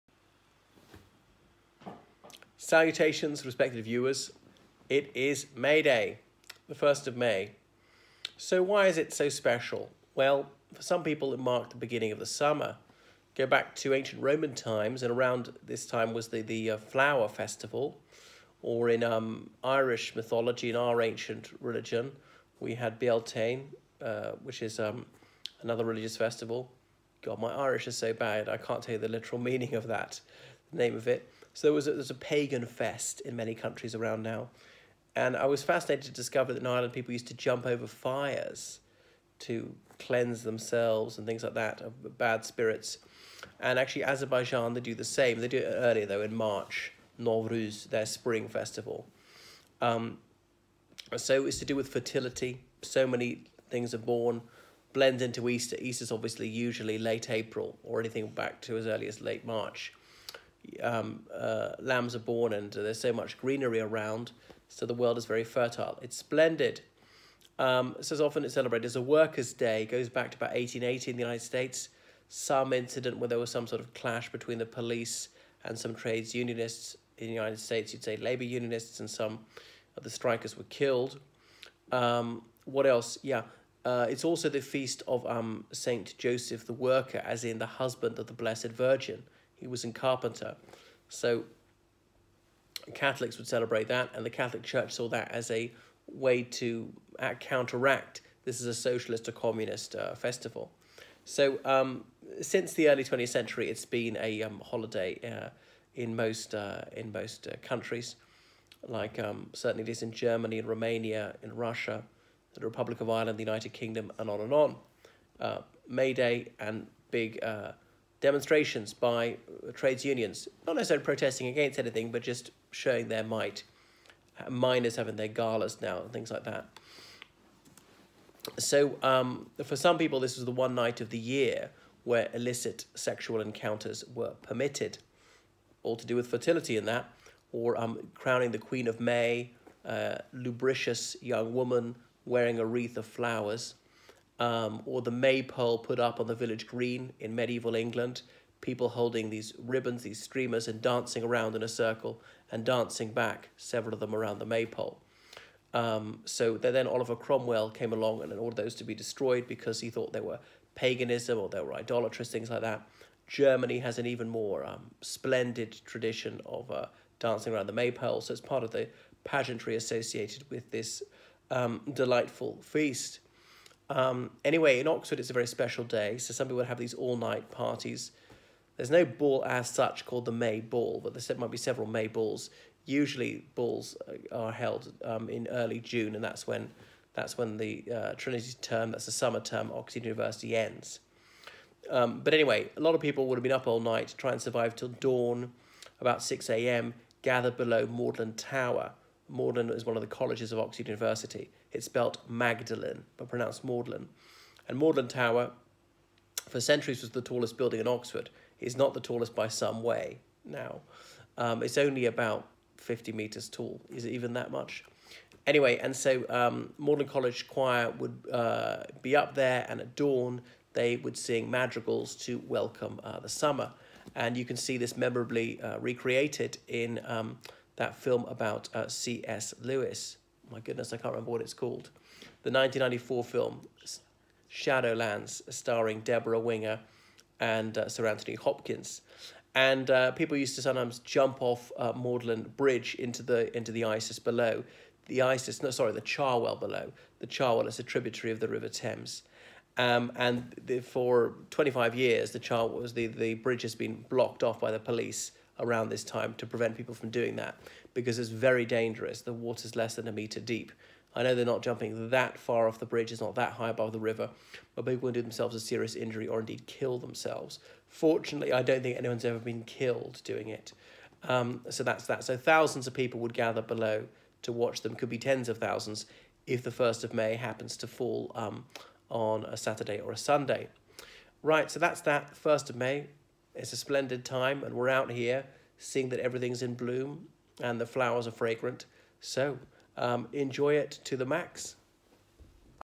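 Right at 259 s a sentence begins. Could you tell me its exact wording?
The water's less than a meter deep.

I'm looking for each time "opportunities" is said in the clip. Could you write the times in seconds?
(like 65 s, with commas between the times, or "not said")
not said.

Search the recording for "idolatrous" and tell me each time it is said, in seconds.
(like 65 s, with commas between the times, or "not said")
161 s.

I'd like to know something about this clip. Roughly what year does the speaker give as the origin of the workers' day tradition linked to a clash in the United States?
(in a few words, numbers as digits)
1880.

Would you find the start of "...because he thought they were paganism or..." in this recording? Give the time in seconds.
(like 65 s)
159 s.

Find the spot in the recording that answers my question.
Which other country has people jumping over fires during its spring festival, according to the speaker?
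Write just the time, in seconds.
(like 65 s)
44 s.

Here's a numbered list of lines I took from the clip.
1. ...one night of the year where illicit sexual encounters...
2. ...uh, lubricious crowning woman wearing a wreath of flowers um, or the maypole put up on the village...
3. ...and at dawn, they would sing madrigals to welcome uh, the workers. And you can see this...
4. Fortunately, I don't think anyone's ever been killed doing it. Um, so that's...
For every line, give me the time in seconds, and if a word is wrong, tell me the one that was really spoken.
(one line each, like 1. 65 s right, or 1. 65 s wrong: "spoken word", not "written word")
1. 130 s right
2. 139 s wrong: "young", not "crowning"
3. 219 s wrong: "summer", not "workers"
4. 267 s right.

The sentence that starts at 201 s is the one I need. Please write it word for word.
It's spelt Magdalen, but pronounced Magdalen.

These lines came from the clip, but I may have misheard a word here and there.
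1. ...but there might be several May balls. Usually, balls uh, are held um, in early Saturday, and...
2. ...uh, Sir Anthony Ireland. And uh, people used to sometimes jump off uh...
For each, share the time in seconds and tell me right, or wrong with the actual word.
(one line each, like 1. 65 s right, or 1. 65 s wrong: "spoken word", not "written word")
1. 181 s wrong: "June", not "Saturday"
2. 237 s wrong: "Hopkins", not "Ireland".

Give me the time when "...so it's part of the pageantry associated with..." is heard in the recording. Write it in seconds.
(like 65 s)
168 s.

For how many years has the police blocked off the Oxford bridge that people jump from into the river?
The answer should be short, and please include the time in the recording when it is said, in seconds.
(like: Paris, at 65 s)
25, at 251 s.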